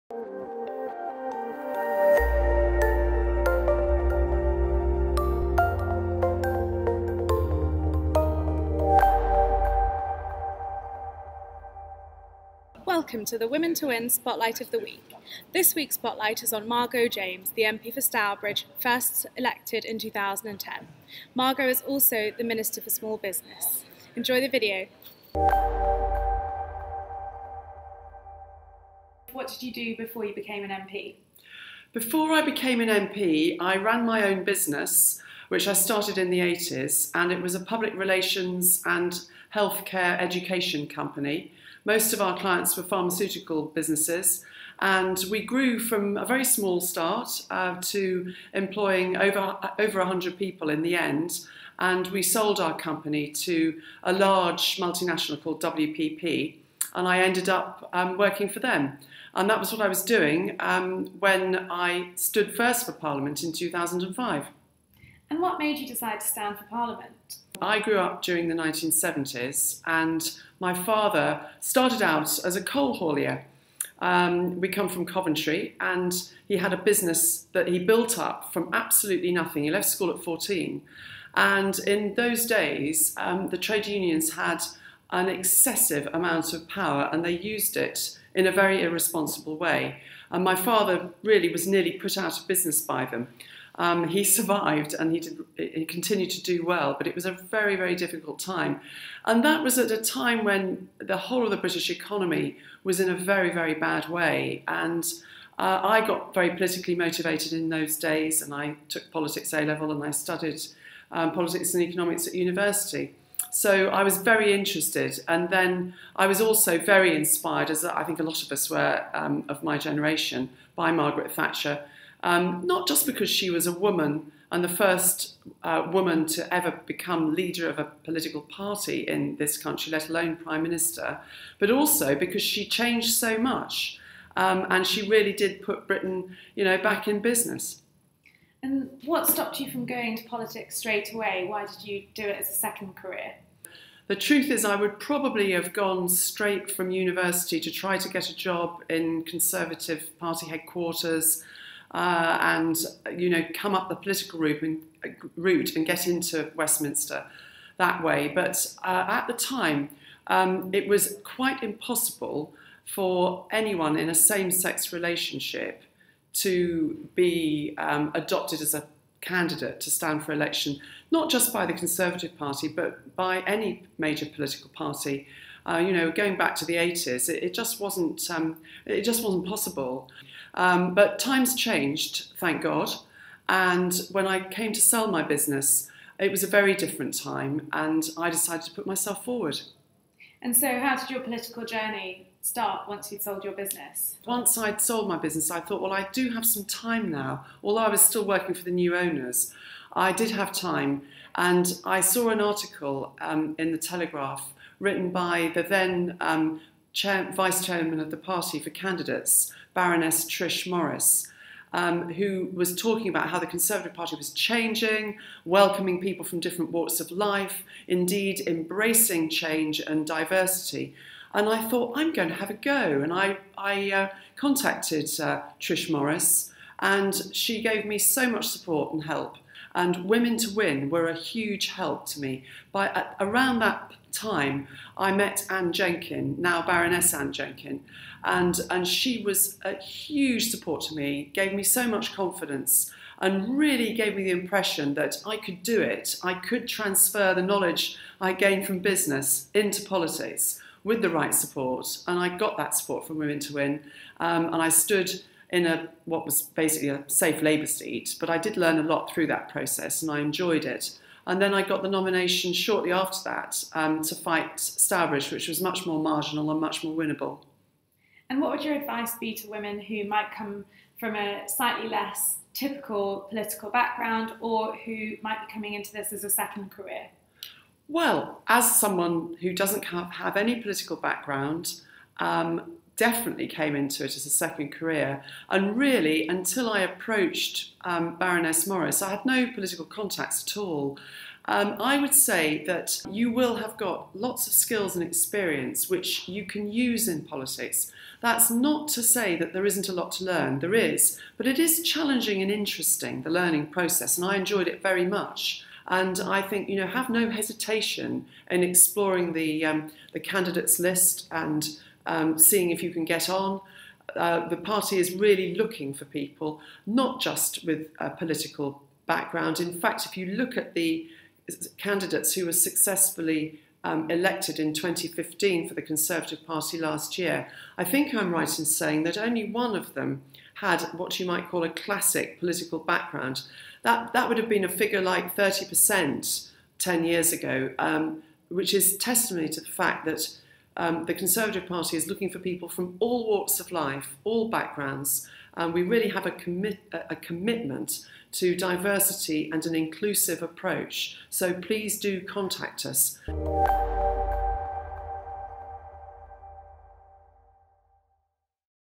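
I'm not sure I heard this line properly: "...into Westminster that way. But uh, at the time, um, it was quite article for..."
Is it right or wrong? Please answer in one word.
wrong.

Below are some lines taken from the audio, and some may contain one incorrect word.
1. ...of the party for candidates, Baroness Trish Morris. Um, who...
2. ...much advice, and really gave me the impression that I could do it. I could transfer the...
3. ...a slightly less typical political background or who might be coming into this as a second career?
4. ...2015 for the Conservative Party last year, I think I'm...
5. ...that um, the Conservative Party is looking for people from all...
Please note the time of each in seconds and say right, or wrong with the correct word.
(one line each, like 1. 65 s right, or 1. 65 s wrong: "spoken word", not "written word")
1. 208 s right
2. 241 s wrong: "confidence", not "advice"
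3. 271 s right
4. 324 s right
5. 340 s right.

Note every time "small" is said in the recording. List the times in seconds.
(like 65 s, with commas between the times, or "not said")
22 s, 46 s.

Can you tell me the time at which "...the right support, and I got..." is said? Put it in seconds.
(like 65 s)
251 s.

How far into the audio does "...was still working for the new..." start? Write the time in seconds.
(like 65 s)
197 s.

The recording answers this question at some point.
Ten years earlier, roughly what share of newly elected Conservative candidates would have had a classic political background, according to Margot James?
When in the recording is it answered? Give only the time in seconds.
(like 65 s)
335 s.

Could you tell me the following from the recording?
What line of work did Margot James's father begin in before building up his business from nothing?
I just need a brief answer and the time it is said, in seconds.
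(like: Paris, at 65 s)
Coal haulier, at 72 s.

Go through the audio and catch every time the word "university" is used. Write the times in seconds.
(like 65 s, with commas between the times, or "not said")
112 s, 146 s.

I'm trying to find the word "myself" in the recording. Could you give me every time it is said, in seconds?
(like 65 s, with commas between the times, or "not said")
188 s.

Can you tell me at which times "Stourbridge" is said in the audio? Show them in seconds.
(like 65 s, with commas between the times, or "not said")
18 s, 264 s.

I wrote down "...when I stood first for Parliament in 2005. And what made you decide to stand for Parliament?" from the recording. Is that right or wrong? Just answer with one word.
right.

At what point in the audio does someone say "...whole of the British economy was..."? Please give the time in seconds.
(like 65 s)
101 s.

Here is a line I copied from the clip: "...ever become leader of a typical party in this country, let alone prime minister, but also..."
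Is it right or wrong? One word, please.
wrong.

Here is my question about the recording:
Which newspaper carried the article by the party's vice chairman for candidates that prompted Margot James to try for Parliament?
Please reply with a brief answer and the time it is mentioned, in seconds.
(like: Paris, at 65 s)
The Telegraph, at 203 s.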